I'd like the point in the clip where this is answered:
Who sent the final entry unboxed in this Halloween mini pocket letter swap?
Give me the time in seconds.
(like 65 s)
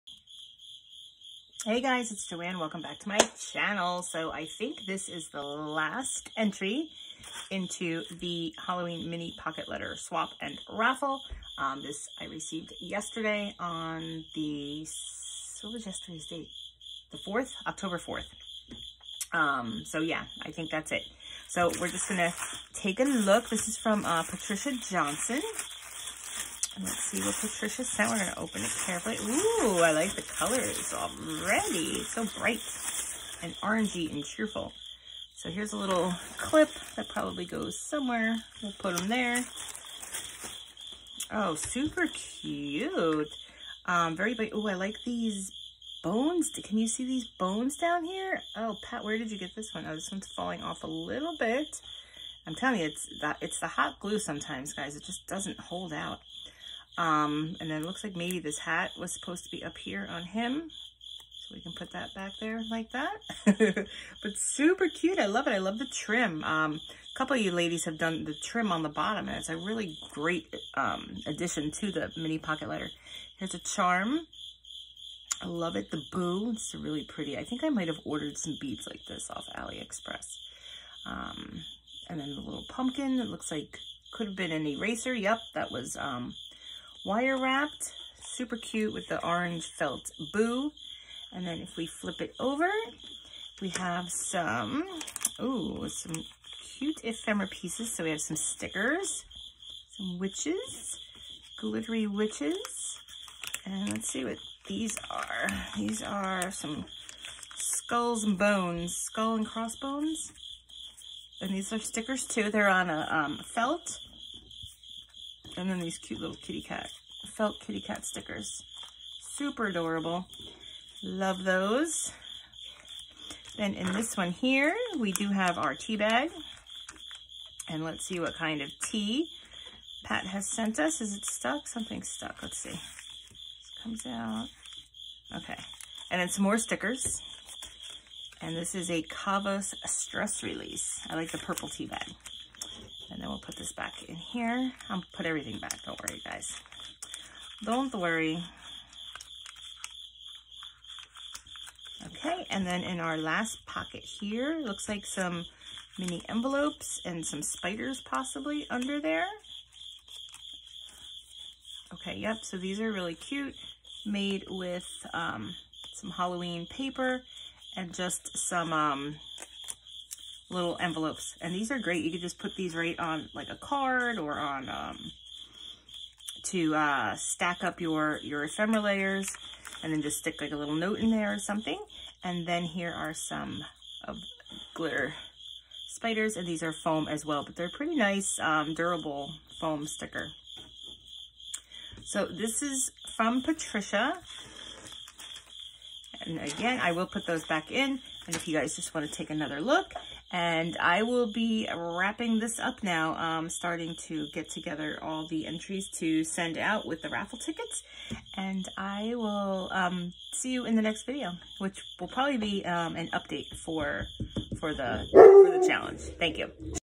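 24 s.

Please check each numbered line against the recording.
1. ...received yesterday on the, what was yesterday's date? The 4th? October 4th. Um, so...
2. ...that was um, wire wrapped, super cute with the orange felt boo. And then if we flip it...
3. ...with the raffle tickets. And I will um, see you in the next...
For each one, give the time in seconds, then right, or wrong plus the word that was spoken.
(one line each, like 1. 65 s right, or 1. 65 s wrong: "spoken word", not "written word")
1. 12 s right
2. 85 s right
3. 206 s right.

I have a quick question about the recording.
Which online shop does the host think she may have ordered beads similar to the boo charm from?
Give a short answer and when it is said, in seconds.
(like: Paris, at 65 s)
AliExpress, at 79 s.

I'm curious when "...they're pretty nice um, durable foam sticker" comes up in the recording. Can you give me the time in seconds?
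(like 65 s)
187 s.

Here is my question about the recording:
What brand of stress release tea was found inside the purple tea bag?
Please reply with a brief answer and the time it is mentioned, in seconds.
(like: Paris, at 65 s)
Cavos, at 139 s.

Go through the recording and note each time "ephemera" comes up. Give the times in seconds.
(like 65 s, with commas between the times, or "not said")
97 s, 178 s.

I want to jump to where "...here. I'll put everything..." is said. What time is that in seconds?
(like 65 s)
144 s.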